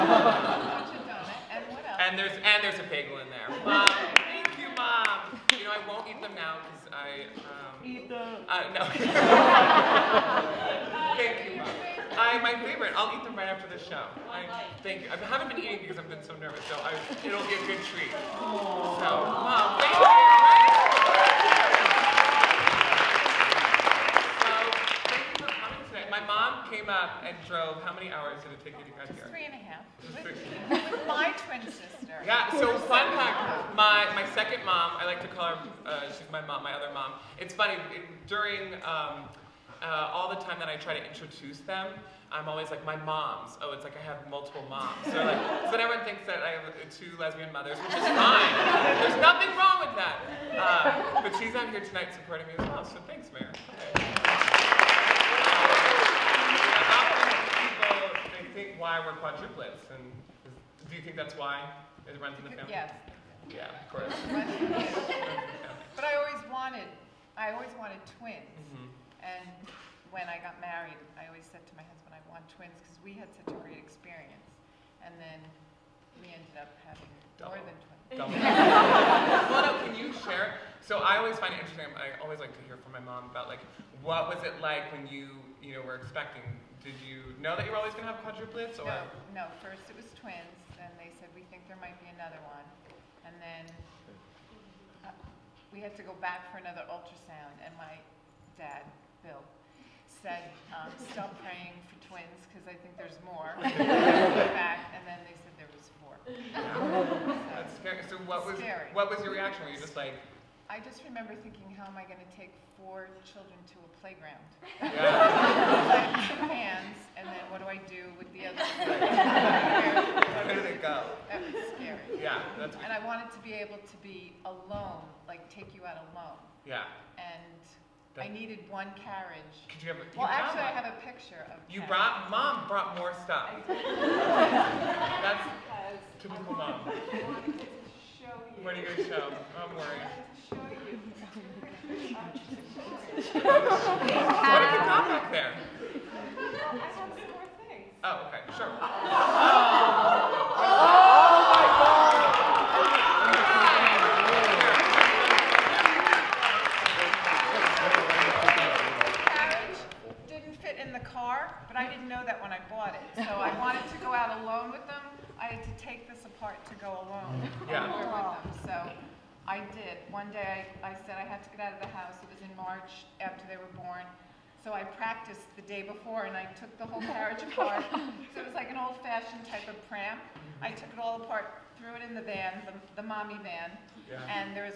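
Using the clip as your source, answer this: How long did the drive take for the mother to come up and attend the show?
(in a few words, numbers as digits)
3.5 hours.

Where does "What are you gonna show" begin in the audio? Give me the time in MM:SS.
02:18.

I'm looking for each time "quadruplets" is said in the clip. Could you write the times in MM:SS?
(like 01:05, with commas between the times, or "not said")
00:59, 01:28.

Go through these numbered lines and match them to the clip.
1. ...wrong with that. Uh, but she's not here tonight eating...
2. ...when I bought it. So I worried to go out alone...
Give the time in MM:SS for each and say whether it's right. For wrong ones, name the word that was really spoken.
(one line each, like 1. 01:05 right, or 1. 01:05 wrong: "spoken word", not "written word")
1. 00:49 wrong: "supporting", not "eating"
2. 02:42 wrong: "wanted", not "worried".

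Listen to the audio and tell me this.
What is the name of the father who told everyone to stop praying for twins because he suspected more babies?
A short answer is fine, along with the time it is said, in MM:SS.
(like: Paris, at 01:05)
Bill, at 01:39.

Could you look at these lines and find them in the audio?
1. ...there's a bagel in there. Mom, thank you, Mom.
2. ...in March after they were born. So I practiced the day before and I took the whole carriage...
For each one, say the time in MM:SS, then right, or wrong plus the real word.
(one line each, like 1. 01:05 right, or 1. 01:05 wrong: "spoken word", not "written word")
1. 00:02 right
2. 02:52 right.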